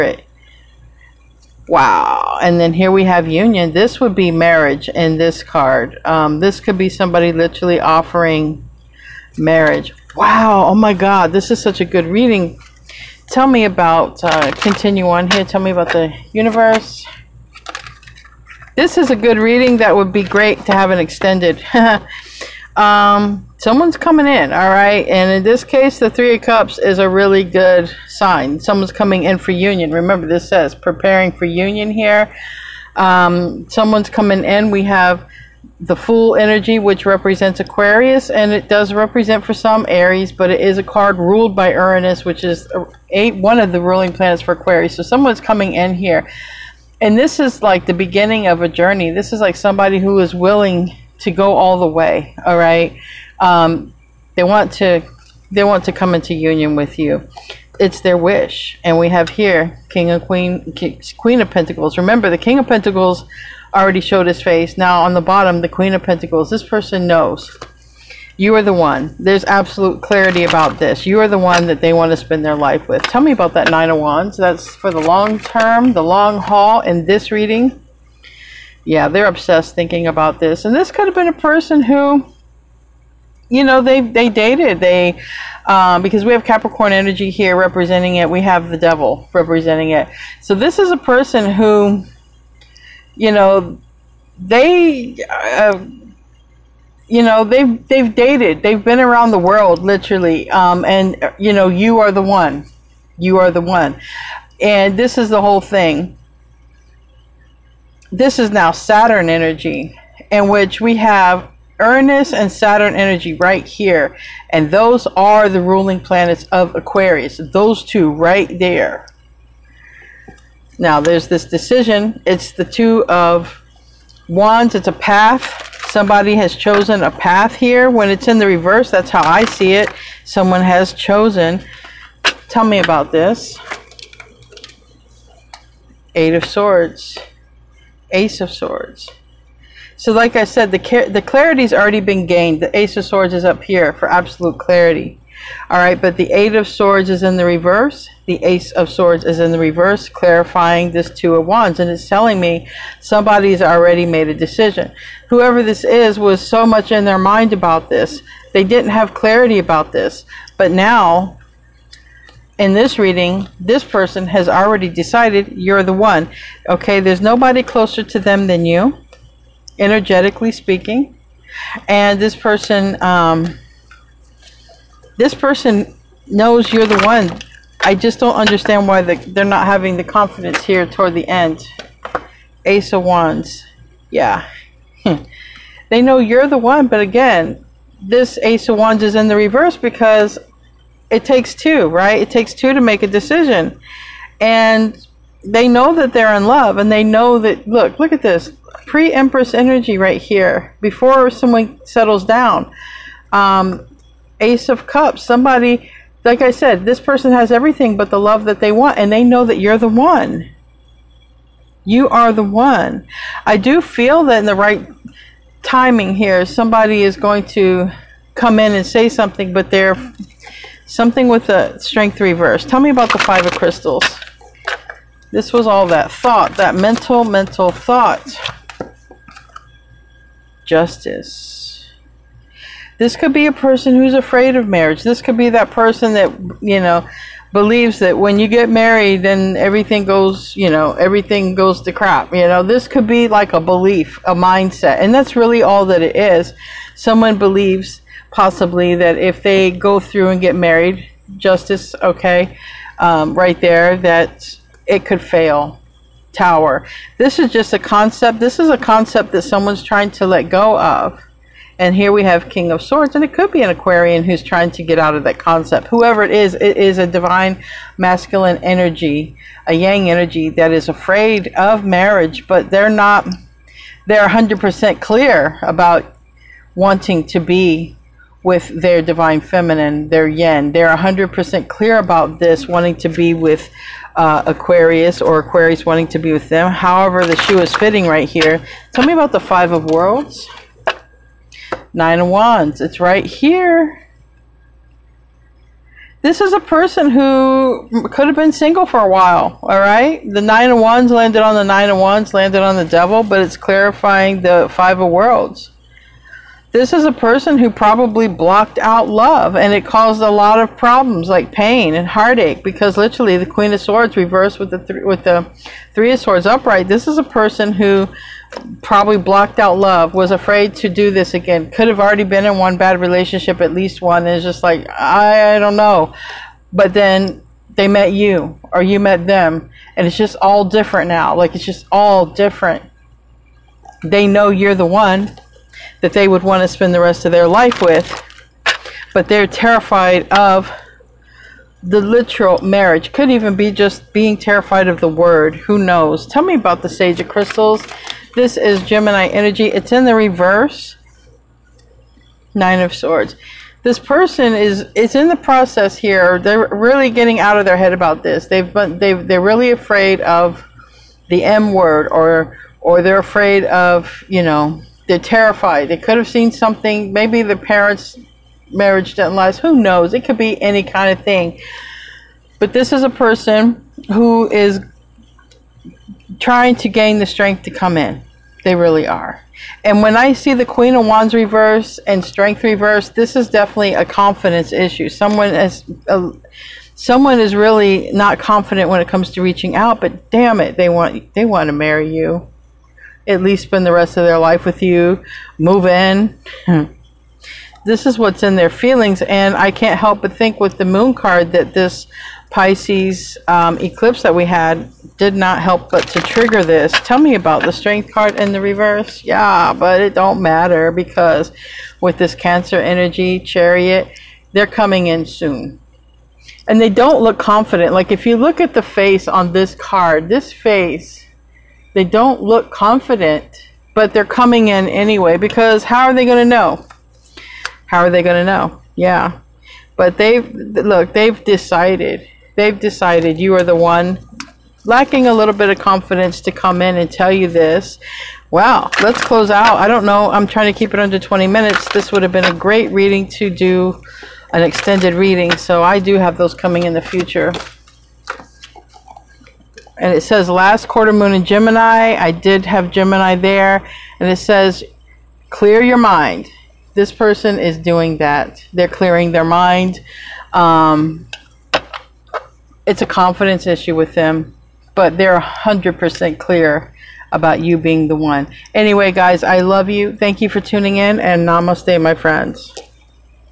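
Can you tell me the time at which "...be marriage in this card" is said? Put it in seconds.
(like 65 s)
4 s.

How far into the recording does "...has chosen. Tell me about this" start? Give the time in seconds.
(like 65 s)
130 s.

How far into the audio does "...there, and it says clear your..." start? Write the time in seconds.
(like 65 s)
453 s.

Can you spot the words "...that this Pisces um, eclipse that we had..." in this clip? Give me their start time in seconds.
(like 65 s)
401 s.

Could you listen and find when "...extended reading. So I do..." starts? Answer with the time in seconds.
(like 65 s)
444 s.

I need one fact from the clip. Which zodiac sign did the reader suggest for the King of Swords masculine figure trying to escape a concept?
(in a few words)
Aquarian.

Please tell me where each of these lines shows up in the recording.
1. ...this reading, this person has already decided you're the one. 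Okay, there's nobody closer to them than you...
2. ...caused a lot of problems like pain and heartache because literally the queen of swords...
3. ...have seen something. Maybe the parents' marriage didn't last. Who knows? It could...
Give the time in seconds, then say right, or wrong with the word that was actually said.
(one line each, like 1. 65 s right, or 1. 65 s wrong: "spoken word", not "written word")
1. 162 s right
2. 309 s right
3. 366 s right.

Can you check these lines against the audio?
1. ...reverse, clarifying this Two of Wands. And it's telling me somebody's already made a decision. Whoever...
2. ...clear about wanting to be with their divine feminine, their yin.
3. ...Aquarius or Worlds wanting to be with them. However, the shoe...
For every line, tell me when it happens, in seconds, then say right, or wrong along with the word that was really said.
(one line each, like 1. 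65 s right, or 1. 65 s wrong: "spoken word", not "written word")
1. 149 s right
2. 275 s right
3. 284 s wrong: "Aquarius", not "Worlds".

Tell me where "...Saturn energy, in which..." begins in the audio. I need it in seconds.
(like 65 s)
108 s.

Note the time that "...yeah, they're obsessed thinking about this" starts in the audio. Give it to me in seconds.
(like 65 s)
78 s.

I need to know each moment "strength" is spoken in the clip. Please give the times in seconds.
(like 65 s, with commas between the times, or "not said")
221 s, 377 s, 382 s, 407 s.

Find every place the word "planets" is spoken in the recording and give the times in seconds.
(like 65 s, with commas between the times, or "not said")
44 s, 116 s.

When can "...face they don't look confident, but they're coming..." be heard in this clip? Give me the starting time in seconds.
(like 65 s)
420 s.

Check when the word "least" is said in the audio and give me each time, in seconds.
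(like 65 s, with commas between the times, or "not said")
323 s, 393 s.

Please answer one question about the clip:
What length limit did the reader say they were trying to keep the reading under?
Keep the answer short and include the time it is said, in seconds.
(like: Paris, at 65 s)
20 minutes, at 441 s.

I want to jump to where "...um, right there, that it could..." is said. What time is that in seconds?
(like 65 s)
252 s.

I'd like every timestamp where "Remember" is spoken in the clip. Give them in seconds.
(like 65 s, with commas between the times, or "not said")
29 s, 61 s.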